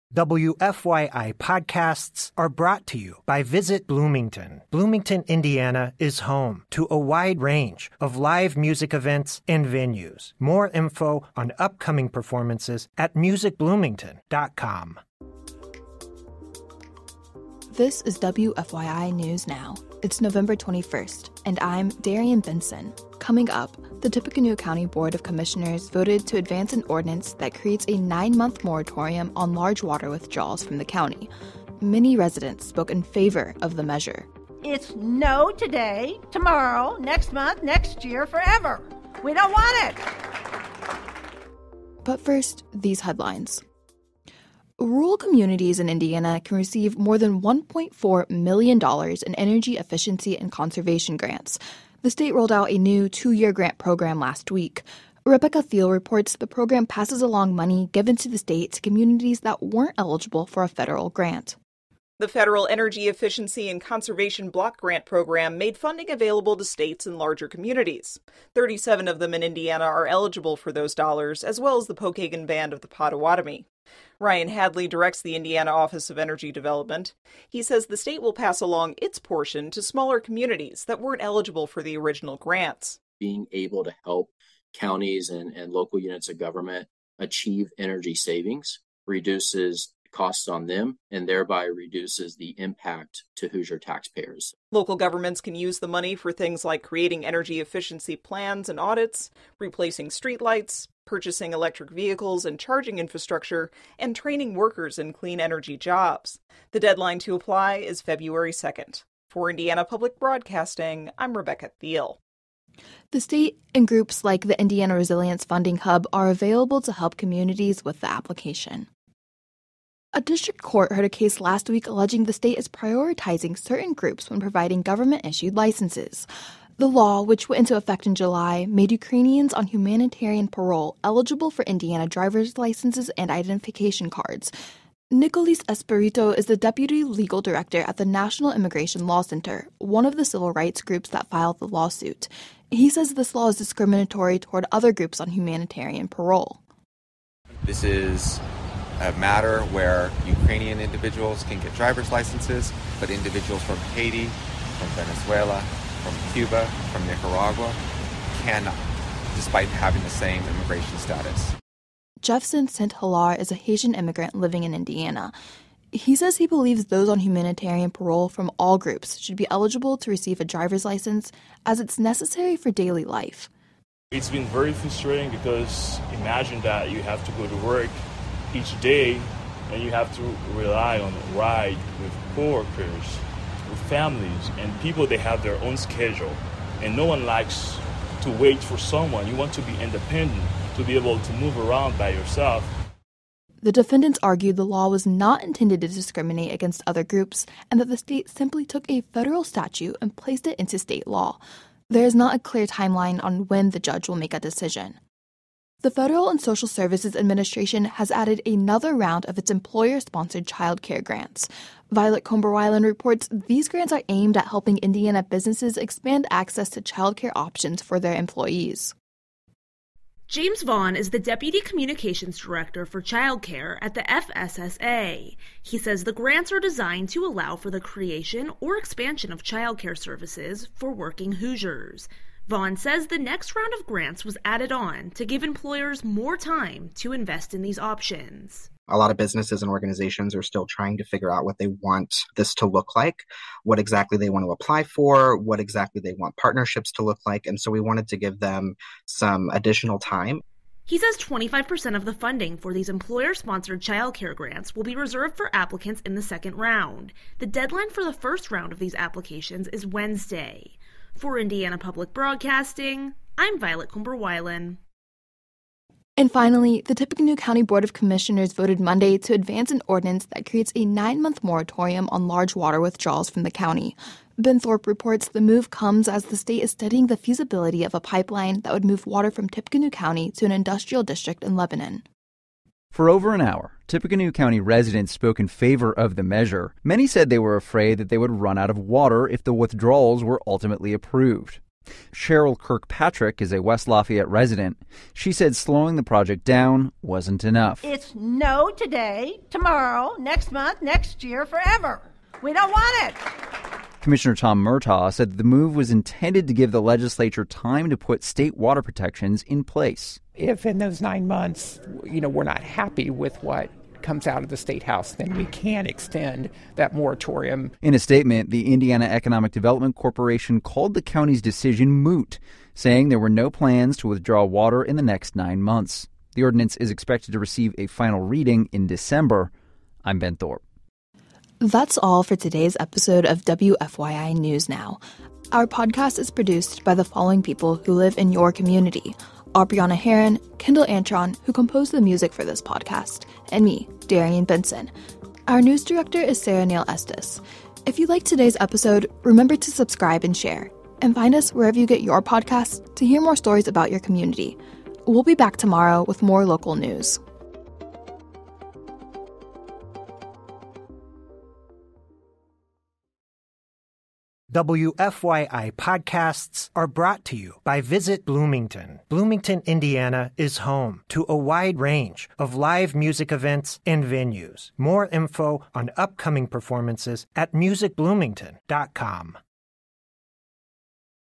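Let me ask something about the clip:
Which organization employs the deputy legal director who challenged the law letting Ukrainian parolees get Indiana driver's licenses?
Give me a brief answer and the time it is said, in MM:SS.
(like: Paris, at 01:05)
National Immigration Law Center, at 02:18.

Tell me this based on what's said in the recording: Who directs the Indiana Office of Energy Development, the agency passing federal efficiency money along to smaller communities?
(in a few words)
Ryan Hadley.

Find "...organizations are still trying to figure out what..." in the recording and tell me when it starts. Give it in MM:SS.
03:59.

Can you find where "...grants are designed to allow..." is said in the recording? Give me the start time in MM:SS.
03:46.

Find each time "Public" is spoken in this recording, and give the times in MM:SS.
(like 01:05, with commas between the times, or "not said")
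01:49, 04:21.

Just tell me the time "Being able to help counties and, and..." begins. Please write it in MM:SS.
01:23.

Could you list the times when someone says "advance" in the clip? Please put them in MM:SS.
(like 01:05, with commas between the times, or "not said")
00:26, 04:29.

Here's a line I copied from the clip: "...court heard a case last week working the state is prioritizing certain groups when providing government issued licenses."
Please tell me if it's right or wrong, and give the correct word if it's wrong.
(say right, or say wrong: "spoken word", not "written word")
wrong: "alleging", not "working".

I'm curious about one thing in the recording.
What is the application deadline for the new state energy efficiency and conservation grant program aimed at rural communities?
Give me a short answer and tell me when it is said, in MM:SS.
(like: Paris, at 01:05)
February 2nd, at 01:48.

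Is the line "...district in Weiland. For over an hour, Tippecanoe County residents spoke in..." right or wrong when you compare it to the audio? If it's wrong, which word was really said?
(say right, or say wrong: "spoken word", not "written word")
wrong: "Lebanon", not "Weiland".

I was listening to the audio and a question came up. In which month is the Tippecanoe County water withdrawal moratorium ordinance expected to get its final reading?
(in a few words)
December.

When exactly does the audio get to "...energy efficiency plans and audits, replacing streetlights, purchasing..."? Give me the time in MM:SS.
01:37.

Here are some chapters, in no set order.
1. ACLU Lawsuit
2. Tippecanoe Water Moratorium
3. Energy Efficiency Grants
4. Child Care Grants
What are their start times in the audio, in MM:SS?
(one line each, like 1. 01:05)
1. 01:59
2. 04:25
3. 00:43
4. 03:25.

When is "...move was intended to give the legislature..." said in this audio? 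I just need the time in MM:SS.
05:05.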